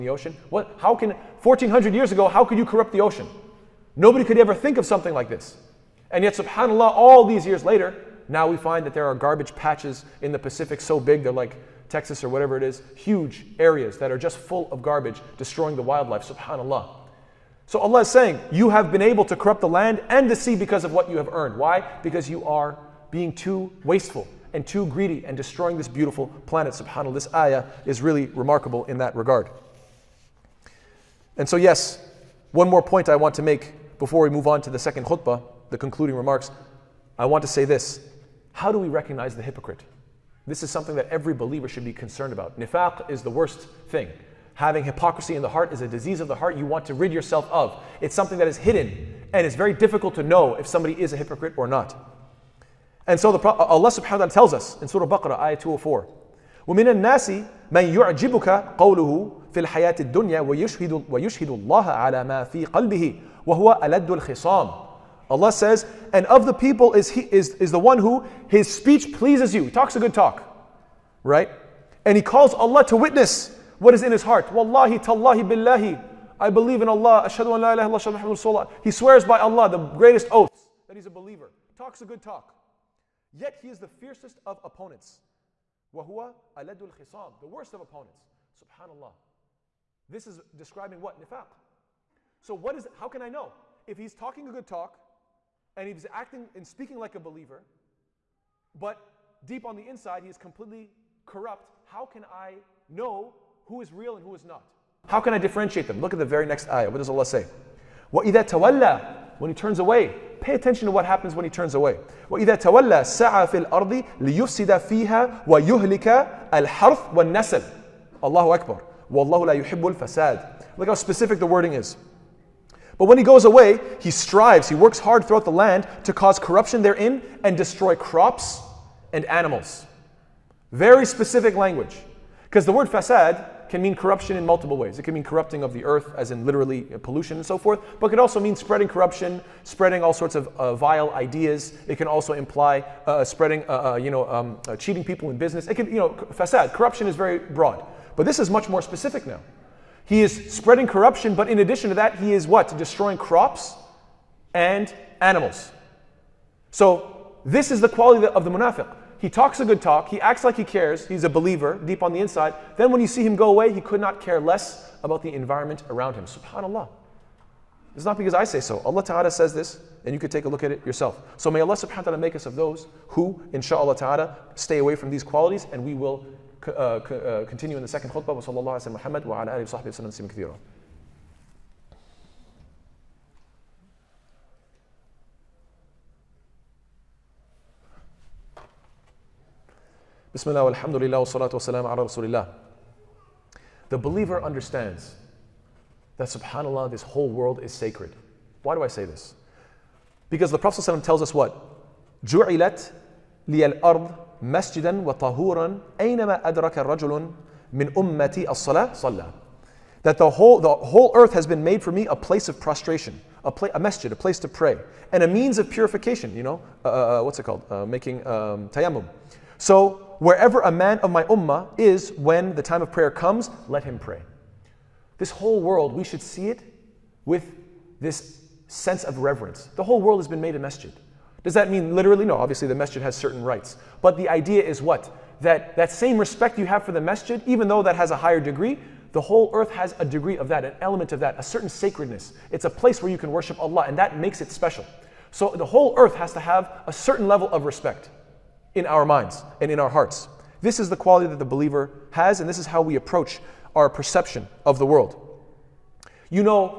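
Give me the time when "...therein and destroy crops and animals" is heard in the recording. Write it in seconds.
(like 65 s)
126 s.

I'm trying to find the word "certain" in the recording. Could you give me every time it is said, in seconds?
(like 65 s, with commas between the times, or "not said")
233 s, 241 s, 246 s.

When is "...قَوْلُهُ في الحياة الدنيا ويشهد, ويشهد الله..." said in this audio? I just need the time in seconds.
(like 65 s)
58 s.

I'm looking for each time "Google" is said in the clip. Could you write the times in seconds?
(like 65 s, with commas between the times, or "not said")
not said.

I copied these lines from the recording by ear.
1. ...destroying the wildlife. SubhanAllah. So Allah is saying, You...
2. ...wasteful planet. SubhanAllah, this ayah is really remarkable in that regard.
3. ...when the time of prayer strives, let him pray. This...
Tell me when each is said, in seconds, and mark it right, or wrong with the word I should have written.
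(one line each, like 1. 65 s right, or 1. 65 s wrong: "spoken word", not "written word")
1. 15 s right
2. 25 s wrong: "beautiful", not "wasteful"
3. 222 s wrong: "comes", not "strives".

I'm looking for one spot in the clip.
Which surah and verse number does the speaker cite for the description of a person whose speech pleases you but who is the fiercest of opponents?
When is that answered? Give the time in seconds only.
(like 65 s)
54 s.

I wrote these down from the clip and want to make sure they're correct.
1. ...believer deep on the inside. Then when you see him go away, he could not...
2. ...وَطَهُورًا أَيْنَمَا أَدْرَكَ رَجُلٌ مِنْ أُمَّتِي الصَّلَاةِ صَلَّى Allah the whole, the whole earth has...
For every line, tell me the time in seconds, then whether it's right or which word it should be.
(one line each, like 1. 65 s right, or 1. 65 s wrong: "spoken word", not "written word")
1. 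161 s right
2. 205 s wrong: "That", not "Allah".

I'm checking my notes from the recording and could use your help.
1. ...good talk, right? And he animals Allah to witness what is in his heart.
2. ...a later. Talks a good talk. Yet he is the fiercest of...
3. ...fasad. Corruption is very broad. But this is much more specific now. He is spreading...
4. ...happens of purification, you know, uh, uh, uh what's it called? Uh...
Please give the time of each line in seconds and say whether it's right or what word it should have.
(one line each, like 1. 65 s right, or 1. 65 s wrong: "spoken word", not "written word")
1. 69 s wrong: "calls", not "animals"
2. 81 s wrong: "believer", not "later"
3. 146 s right
4. 215 s wrong: "means", not "happens".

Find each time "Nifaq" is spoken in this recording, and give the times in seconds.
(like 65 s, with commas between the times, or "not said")
42 s, 91 s.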